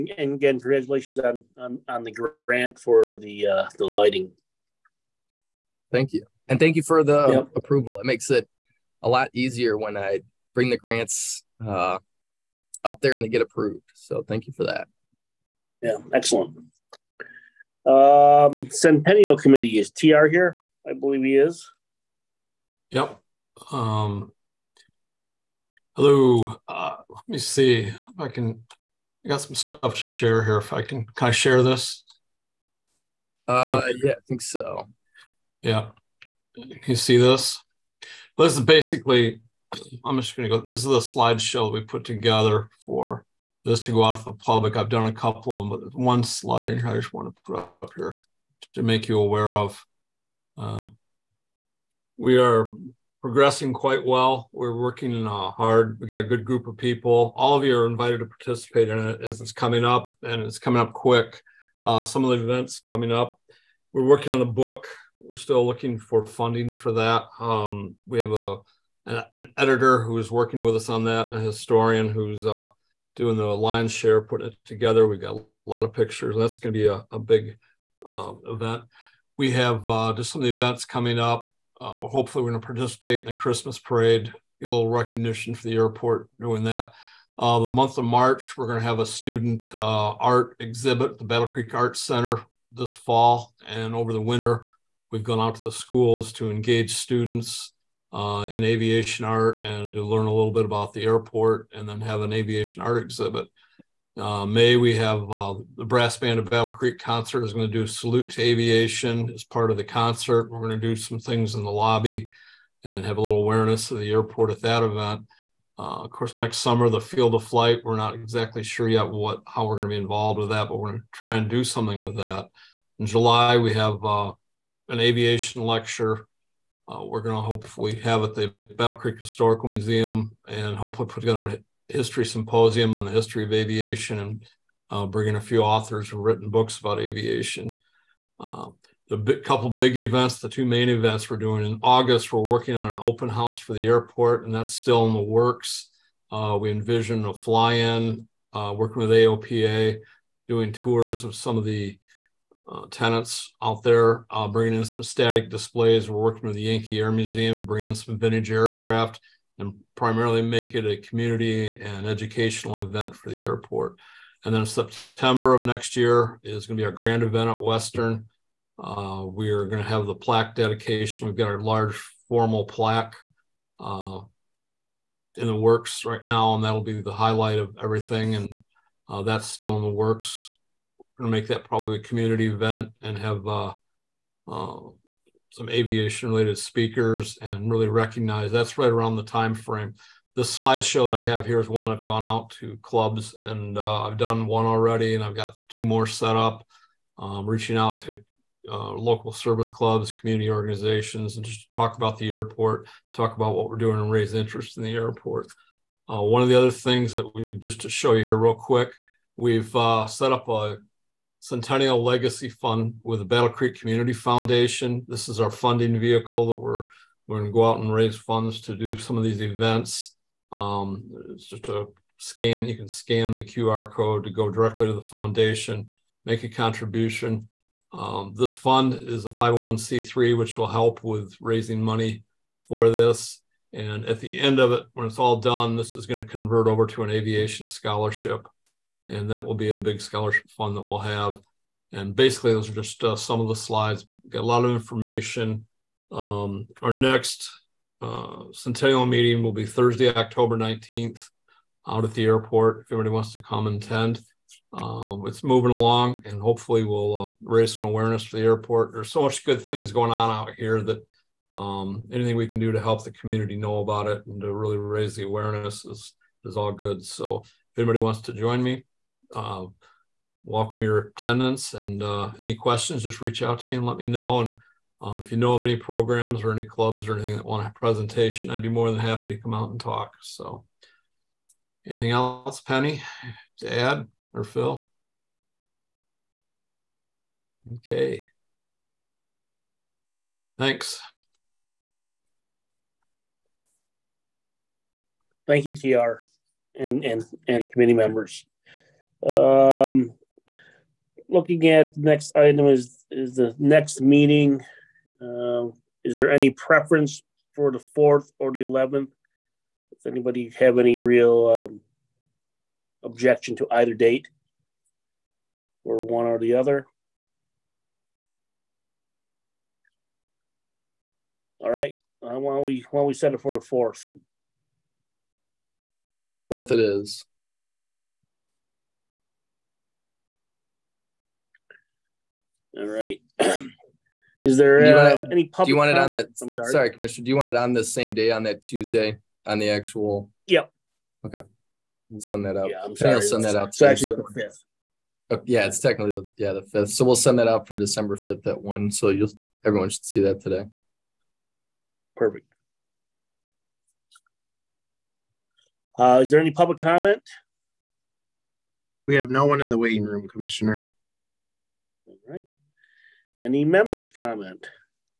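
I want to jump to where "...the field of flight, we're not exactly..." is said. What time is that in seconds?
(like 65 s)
116 s.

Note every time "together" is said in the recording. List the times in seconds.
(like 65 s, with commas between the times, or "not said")
42 s, 74 s, 131 s.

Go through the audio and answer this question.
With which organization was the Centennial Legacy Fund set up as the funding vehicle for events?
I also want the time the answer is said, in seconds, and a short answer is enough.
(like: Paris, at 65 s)
Battle Creek Community Foundation, at 213 s.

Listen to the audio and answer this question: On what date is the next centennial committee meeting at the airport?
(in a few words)
October 19th.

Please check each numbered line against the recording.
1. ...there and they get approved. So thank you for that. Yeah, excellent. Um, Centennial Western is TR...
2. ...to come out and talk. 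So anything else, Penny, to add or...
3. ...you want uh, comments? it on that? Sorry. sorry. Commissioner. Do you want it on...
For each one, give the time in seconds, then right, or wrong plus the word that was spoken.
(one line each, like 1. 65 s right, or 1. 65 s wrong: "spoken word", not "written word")
1. 12 s wrong: "Committee", not "Western"
2. 279 s right
3. 335 s right.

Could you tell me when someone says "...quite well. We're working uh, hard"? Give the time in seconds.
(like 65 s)
53 s.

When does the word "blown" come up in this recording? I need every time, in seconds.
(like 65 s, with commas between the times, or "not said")
not said.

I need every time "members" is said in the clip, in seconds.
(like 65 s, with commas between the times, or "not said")
297 s, 363 s.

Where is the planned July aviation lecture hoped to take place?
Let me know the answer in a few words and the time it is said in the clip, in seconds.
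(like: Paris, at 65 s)
Battle Creek Historical Museum, at 128 s.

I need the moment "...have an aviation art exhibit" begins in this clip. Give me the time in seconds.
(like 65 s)
101 s.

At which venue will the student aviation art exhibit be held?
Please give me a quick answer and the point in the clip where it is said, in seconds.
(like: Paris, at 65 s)
Battle Creek Arts Center, at 91 s.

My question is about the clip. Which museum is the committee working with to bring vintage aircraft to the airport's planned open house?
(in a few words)
Yankee Air Museum.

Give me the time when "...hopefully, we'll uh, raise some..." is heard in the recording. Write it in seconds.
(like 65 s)
256 s.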